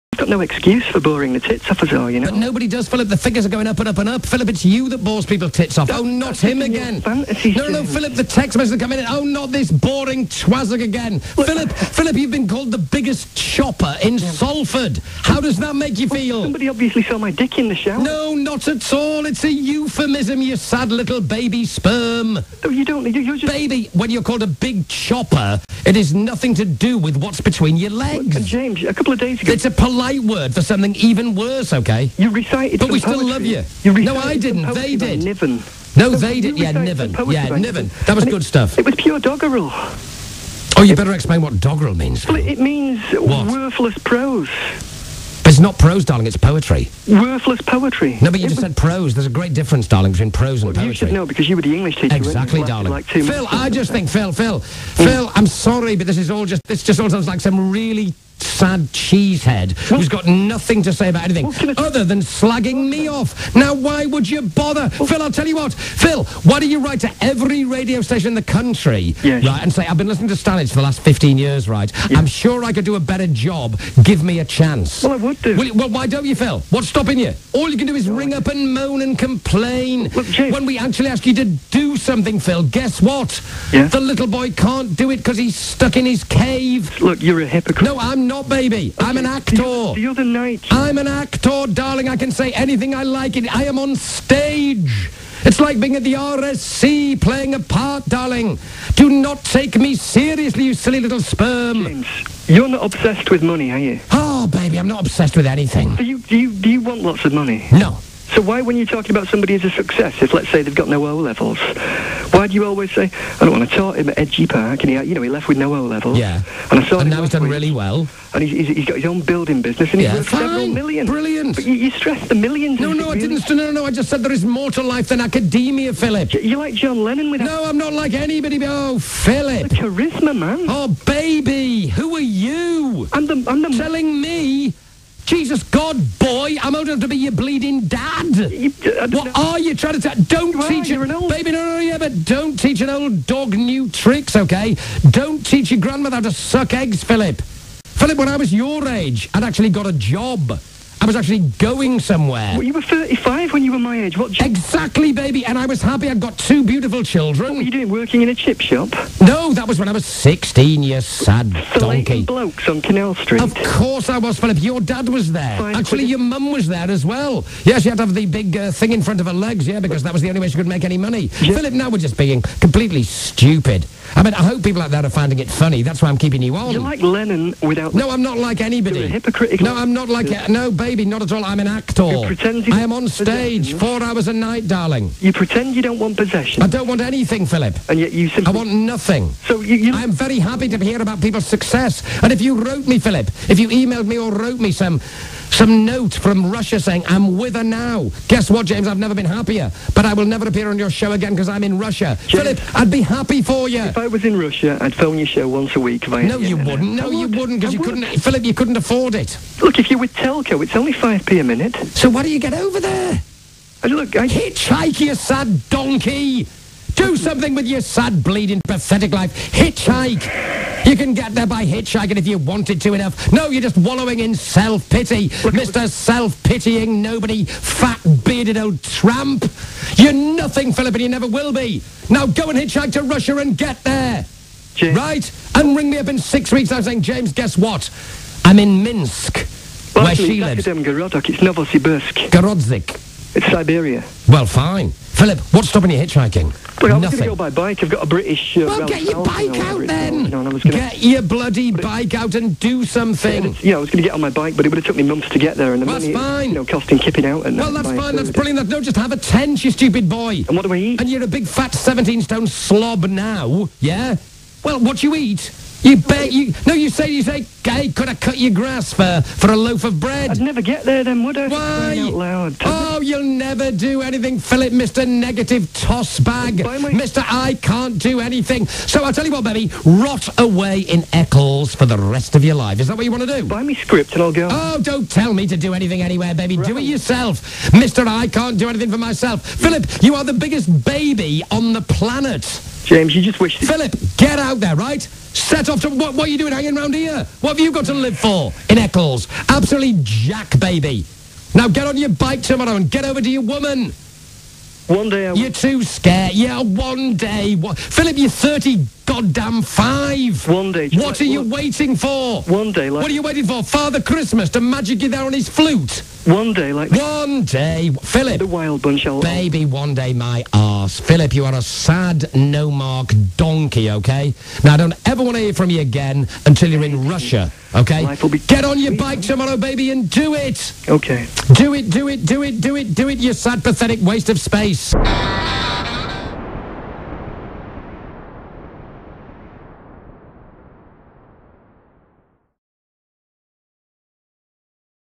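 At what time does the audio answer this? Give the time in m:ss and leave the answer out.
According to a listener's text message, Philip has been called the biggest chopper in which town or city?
0:14.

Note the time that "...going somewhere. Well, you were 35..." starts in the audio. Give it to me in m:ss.
2:31.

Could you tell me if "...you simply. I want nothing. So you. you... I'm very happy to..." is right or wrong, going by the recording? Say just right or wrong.
right.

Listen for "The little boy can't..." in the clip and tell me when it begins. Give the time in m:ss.
1:23.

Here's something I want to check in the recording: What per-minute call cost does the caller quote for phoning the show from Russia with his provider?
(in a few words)
5p.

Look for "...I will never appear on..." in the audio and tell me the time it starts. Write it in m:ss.
3:20.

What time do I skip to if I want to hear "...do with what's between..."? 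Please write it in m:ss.
0:26.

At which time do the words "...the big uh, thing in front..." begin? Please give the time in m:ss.
2:48.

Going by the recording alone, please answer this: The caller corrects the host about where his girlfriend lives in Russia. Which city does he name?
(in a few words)
Novosibirsk.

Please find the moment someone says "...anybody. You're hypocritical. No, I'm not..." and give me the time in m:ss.
2:58.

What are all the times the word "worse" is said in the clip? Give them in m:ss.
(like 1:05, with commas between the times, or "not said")
0:31.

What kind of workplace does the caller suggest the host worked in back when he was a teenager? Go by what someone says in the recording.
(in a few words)
Chip shop.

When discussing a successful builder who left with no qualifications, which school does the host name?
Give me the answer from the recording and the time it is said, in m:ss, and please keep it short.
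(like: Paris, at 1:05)
Edgy Park, at 1:54.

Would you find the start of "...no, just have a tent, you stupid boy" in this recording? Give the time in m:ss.
4:18.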